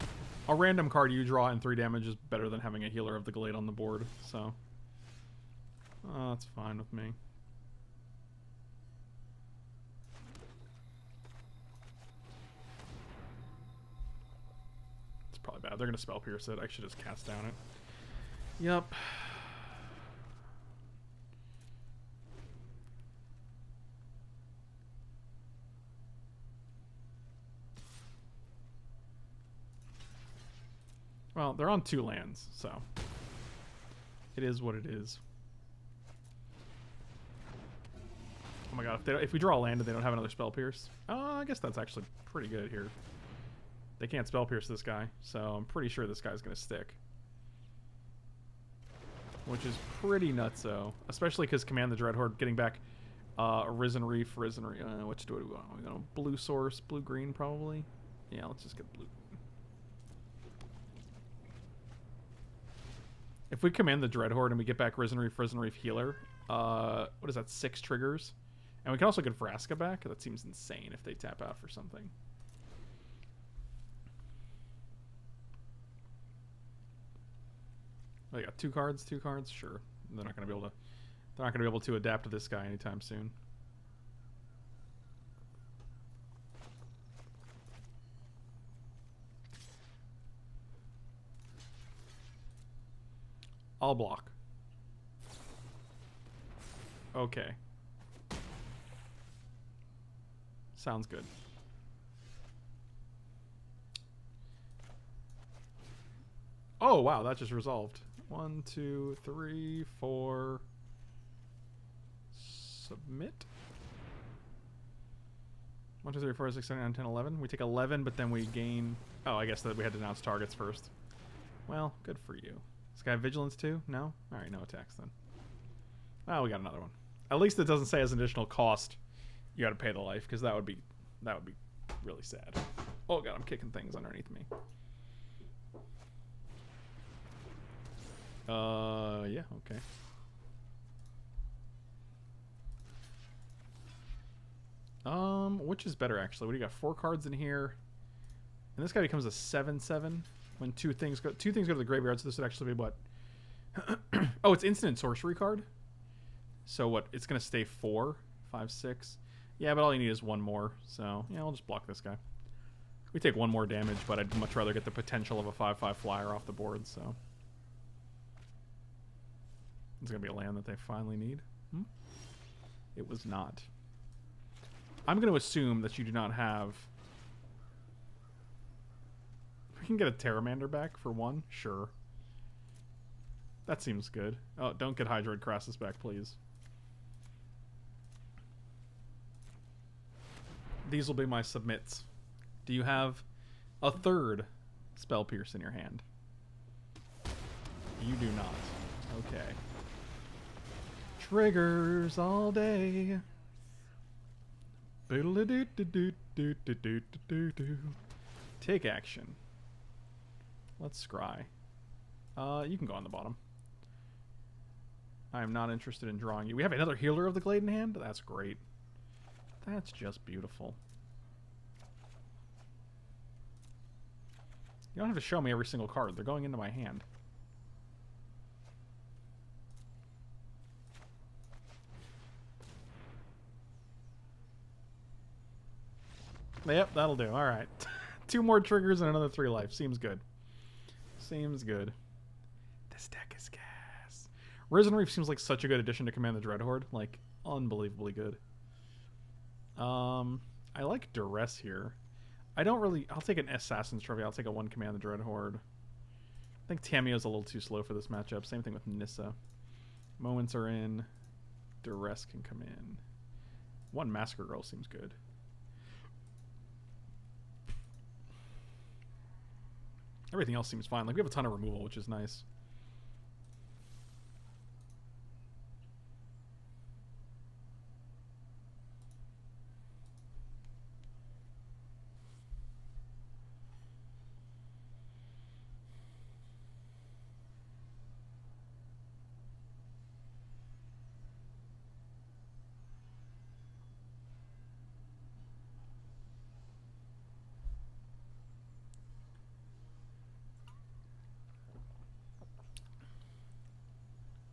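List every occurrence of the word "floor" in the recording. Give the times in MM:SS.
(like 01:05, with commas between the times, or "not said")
not said.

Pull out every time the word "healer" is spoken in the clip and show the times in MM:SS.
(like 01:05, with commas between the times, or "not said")
00:02, 01:05, 03:36.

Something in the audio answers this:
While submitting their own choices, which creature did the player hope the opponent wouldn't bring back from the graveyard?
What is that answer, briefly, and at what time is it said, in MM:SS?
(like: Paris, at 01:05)
Hydroid Krasis, at 03:05.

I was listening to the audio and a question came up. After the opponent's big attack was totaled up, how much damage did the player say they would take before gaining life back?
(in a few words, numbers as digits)
11.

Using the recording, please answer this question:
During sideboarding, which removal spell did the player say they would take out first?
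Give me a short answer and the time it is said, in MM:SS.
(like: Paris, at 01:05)
Assassin's Trophy, at 04:13.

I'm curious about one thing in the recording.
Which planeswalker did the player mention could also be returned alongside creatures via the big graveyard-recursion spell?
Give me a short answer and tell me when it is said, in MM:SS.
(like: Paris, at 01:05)
Vraska, at 01:09.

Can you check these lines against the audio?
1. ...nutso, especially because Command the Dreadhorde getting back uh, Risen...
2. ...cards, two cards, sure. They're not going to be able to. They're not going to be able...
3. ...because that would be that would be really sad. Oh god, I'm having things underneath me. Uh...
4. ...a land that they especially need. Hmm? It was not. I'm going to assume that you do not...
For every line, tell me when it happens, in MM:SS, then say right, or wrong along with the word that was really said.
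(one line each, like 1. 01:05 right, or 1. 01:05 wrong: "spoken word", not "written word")
1. 00:50 right
2. 01:18 right
3. 02:10 wrong: "kicking", not "having"
4. 02:50 wrong: "finally", not "especially".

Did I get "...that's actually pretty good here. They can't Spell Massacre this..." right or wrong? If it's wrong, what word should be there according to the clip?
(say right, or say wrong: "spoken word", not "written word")
wrong: "Pierce", not "Massacre".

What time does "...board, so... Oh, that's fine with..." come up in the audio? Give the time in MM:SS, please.
00:03.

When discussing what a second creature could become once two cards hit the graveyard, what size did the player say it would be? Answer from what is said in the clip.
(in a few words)
7-7.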